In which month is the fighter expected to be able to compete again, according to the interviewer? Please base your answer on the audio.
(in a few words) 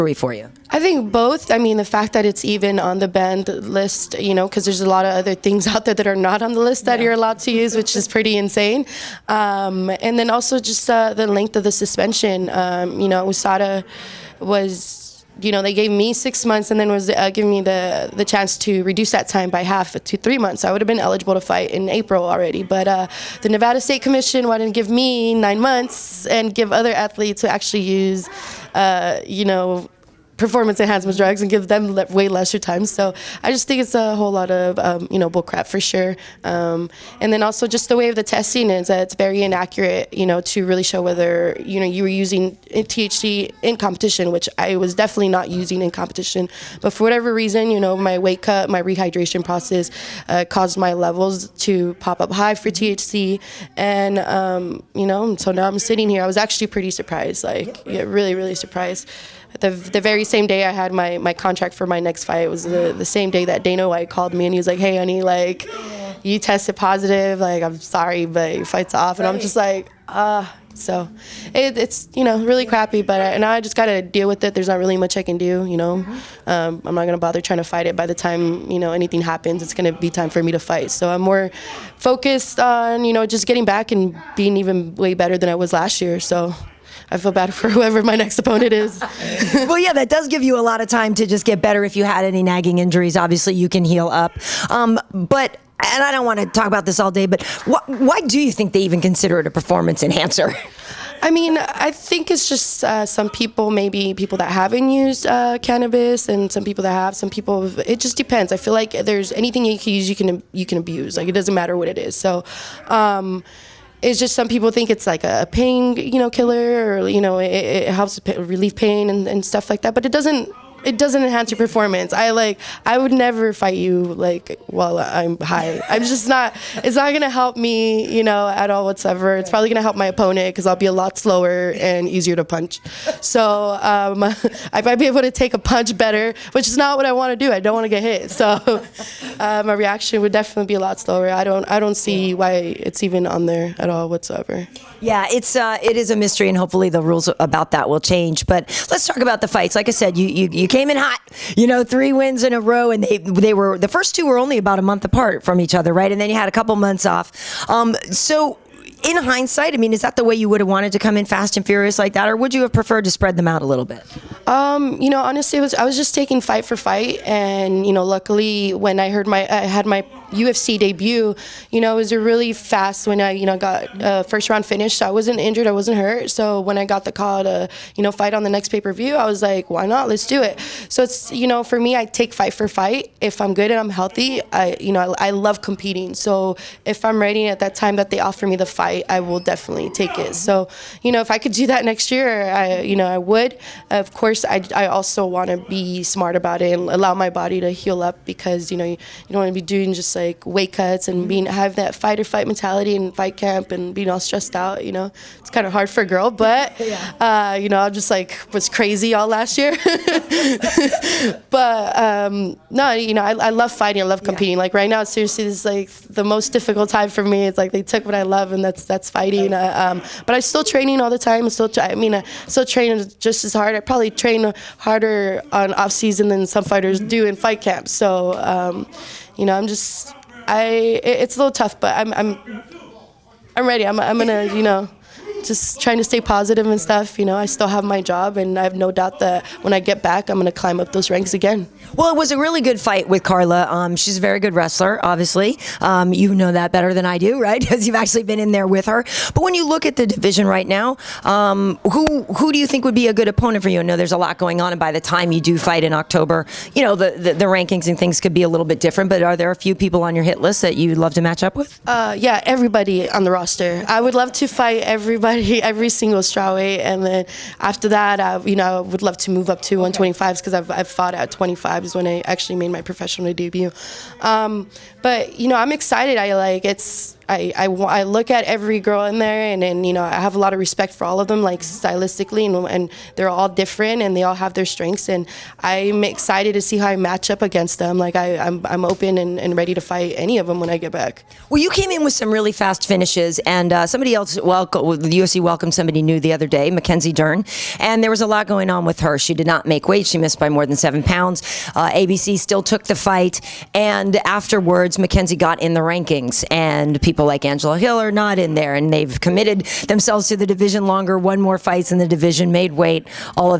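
October.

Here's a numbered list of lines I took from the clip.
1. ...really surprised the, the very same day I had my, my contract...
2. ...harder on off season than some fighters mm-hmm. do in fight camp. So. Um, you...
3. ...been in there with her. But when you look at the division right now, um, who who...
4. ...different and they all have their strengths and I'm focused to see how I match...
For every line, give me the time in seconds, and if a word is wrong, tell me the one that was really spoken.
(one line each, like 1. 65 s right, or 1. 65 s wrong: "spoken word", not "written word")
1. 58 s right
2. 224 s right
3. 248 s right
4. 283 s wrong: "excited", not "focused".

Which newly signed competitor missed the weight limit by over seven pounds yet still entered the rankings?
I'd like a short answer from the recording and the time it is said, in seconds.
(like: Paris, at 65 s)
Mackenzie Dern, at 296 s.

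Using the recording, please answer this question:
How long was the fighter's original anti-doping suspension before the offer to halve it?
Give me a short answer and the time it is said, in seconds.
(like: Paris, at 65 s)
6 months, at 16 s.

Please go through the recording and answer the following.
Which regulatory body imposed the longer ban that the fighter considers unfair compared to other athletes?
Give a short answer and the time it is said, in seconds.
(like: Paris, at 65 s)
Nevada State Commission, at 23 s.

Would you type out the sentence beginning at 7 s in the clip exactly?
you're allowed to use, which is pretty insane.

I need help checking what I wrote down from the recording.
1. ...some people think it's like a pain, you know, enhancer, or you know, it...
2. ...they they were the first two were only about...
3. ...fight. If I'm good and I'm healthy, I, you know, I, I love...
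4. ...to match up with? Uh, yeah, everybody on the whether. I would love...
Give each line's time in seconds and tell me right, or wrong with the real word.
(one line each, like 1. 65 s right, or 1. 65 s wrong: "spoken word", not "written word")
1. 114 s wrong: "killer", not "enhancer"
2. 153 s right
3. 182 s right
4. 261 s wrong: "roster", not "whether".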